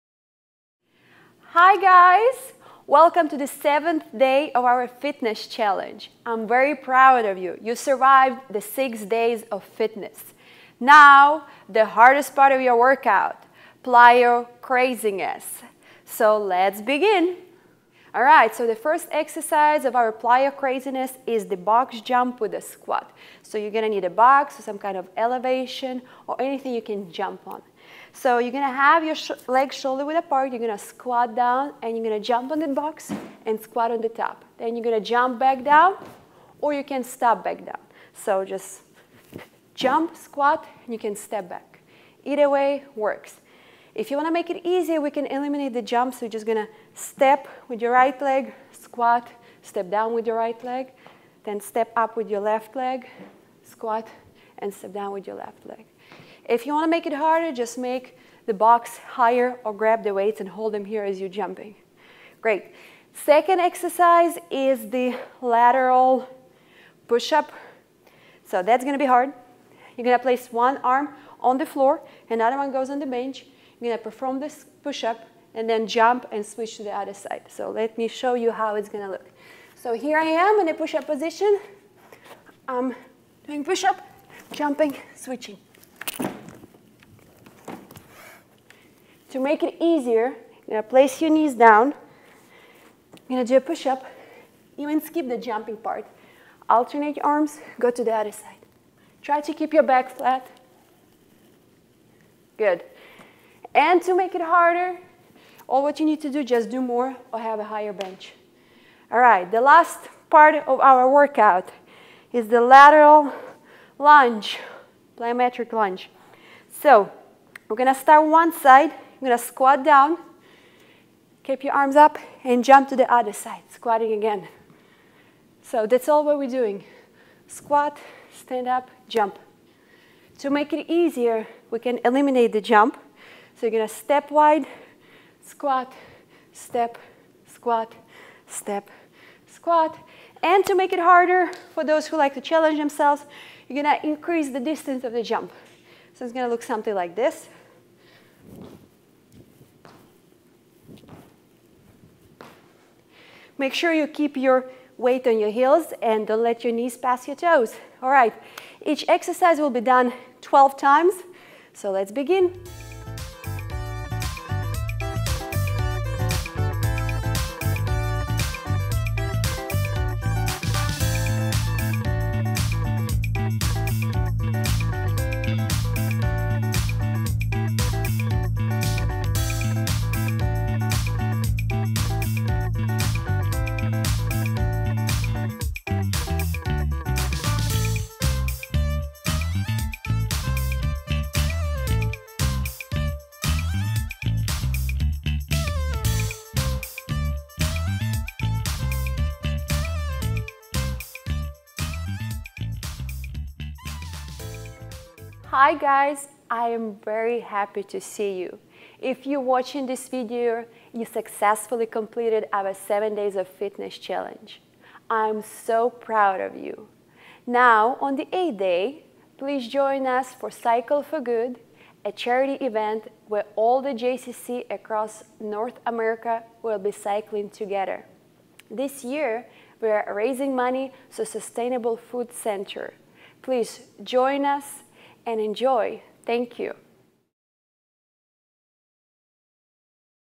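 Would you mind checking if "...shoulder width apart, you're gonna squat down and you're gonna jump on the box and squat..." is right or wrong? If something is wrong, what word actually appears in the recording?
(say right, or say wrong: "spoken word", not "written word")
right.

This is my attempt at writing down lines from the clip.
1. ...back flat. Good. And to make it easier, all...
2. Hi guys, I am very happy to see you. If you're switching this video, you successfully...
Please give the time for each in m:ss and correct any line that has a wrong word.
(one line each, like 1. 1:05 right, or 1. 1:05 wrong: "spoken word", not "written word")
1. 1:39 wrong: "harder", not "easier"
2. 3:25 wrong: "watching", not "switching".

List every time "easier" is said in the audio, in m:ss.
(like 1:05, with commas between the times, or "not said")
0:44, 1:29, 2:10.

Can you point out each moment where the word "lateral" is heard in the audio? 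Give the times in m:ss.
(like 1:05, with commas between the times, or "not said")
1:05, 1:52.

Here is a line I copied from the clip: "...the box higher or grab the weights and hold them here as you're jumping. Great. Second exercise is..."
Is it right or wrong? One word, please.
right.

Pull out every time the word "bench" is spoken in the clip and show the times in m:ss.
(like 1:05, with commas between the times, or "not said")
1:13, 1:47.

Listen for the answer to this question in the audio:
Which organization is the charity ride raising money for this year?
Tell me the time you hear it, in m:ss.
3:51.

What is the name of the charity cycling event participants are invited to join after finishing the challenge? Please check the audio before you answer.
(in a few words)
Cycle for Good.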